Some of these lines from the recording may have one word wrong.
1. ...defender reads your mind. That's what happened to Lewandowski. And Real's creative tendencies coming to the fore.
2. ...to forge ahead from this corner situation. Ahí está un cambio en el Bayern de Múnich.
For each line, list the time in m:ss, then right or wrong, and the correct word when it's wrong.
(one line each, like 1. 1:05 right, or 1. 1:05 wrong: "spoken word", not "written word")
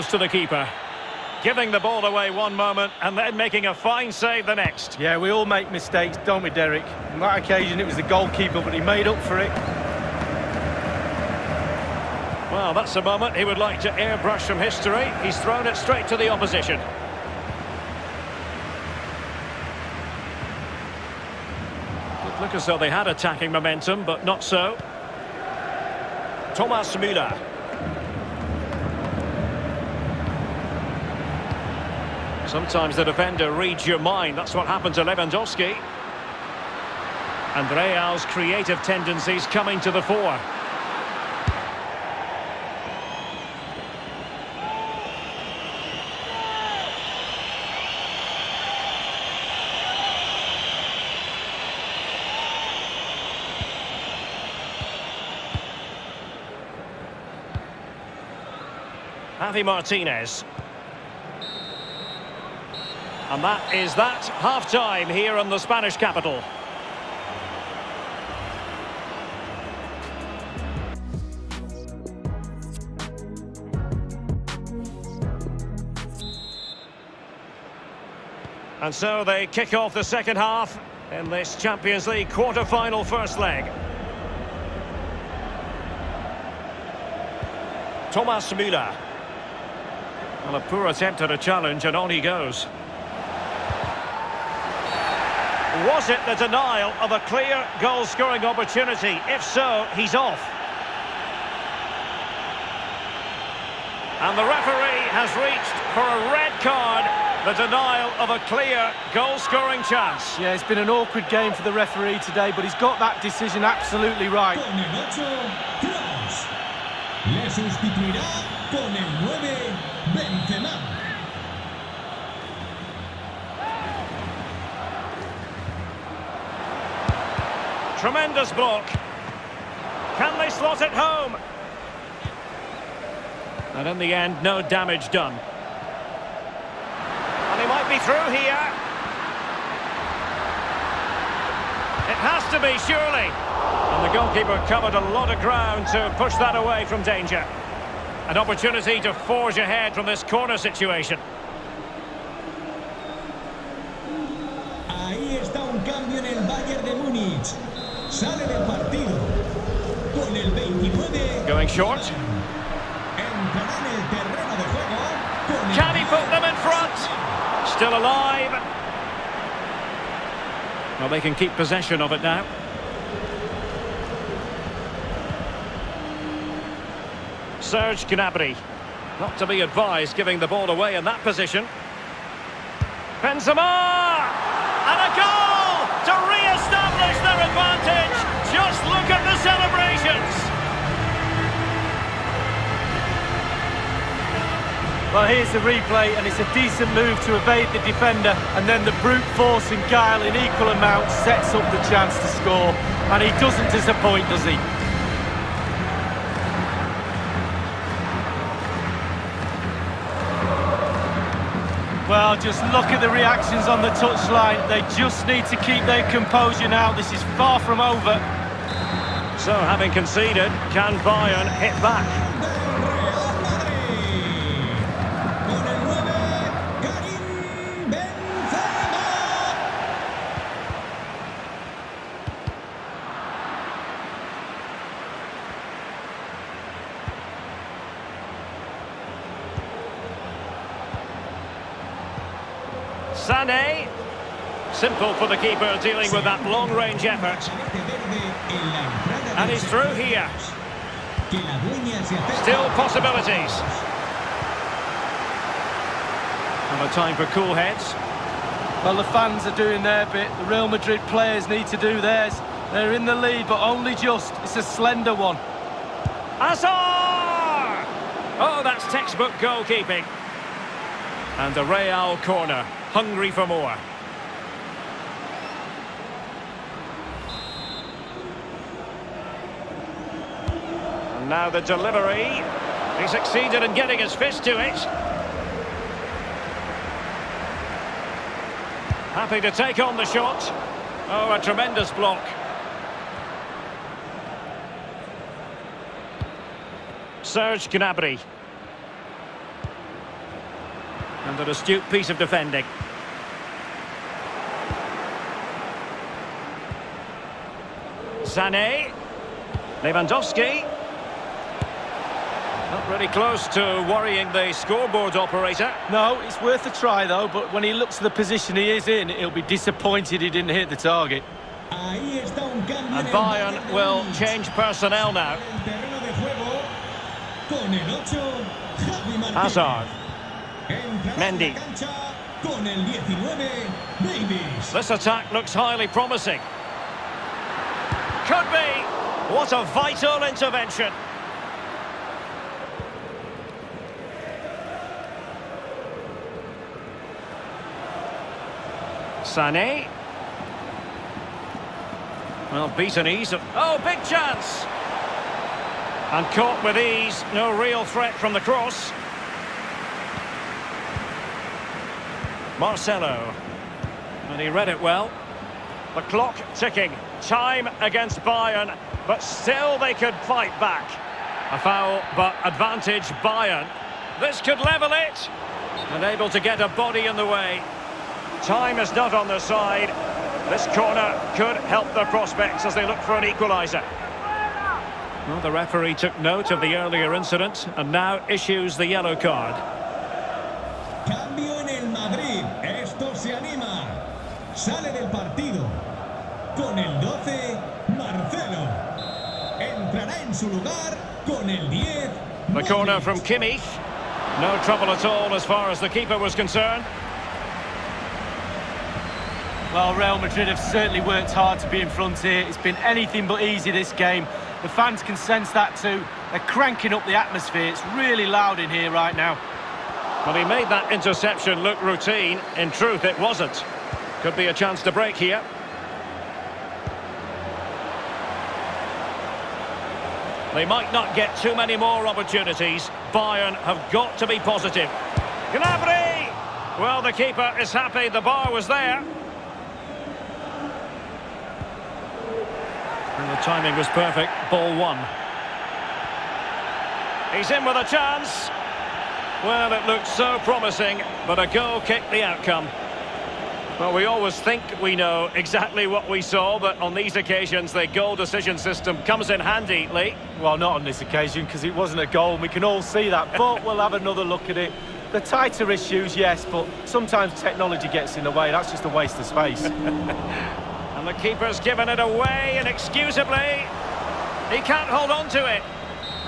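1. 0:33 right
2. 2:29 right.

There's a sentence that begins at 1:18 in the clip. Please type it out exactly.
And so they kick off the second half in this Champions League quarter-final first leg.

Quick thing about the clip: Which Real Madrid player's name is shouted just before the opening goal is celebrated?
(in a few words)
Benzema.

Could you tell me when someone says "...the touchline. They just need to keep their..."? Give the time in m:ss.
3:33.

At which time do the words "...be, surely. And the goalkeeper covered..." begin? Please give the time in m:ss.
2:22.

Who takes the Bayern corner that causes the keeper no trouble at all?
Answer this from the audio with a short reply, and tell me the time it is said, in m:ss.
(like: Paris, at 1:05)
Kimmich, at 6:43.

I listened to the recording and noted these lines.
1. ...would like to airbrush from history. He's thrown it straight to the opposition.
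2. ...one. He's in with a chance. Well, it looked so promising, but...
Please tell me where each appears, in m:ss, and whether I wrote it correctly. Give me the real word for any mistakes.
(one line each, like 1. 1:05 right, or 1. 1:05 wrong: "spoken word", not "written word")
1. 0:13 right
2. 7:24 right.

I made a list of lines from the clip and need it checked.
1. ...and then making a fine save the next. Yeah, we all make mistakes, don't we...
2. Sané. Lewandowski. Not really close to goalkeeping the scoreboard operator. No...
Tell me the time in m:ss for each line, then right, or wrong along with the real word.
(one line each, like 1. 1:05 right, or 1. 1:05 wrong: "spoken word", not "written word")
1. 0:02 right
2. 5:08 wrong: "worrying", not "goalkeeping".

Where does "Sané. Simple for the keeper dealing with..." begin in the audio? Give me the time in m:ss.
4:03.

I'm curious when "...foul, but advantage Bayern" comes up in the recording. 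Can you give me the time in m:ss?
6:11.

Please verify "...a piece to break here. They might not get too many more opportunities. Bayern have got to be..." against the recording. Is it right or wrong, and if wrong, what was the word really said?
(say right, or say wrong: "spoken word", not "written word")
wrong: "chance", not "piece".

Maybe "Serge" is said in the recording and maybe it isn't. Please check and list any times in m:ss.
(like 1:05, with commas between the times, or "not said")
2:57, 4:57.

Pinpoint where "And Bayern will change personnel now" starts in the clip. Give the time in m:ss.
5:21.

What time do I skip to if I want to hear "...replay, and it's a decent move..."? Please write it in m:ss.
3:15.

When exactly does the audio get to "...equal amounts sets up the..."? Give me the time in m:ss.
3:20.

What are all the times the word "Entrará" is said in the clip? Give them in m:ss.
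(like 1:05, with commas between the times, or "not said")
2:43, 6:39.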